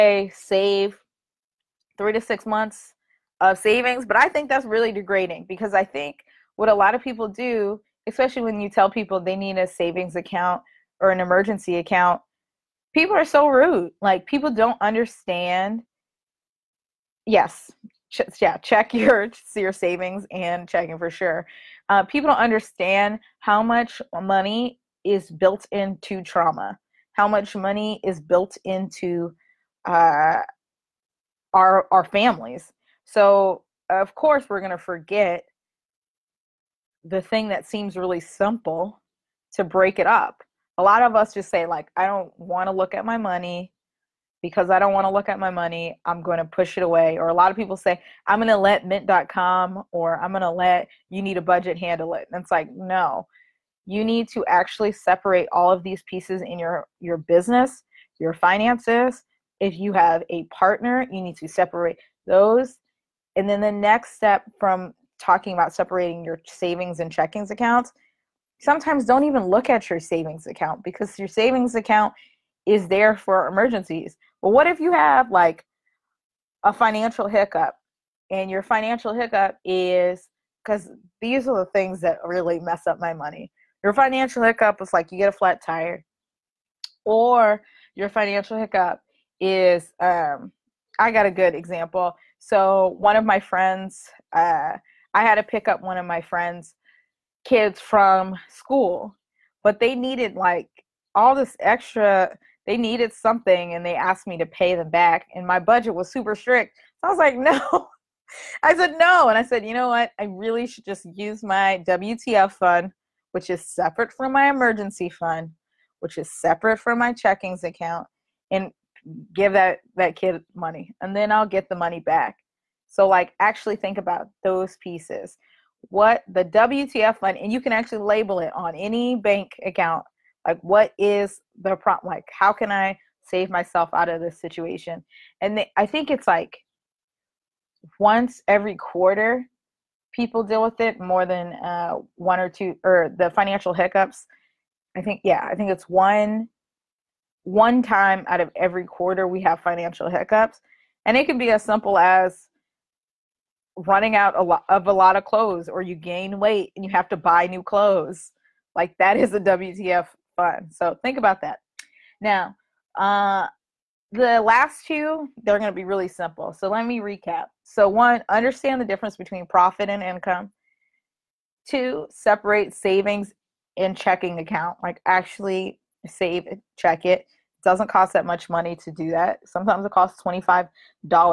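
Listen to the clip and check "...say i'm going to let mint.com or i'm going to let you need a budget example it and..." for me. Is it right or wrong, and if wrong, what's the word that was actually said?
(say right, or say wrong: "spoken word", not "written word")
wrong: "handle", not "example".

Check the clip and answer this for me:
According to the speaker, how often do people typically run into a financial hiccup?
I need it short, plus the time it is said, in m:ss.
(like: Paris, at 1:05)
once every quarter, at 2:17.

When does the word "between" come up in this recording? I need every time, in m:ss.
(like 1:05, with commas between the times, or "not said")
2:49.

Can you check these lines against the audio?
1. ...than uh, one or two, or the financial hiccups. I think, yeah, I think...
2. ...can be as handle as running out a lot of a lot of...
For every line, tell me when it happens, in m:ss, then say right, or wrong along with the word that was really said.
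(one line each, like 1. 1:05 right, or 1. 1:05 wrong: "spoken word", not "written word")
1. 2:21 right
2. 2:31 wrong: "simple", not "handle".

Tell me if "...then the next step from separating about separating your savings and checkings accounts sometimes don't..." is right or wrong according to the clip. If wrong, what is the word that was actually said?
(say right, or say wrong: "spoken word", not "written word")
wrong: "talking", not "separating".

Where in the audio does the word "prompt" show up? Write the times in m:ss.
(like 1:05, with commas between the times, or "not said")
2:11.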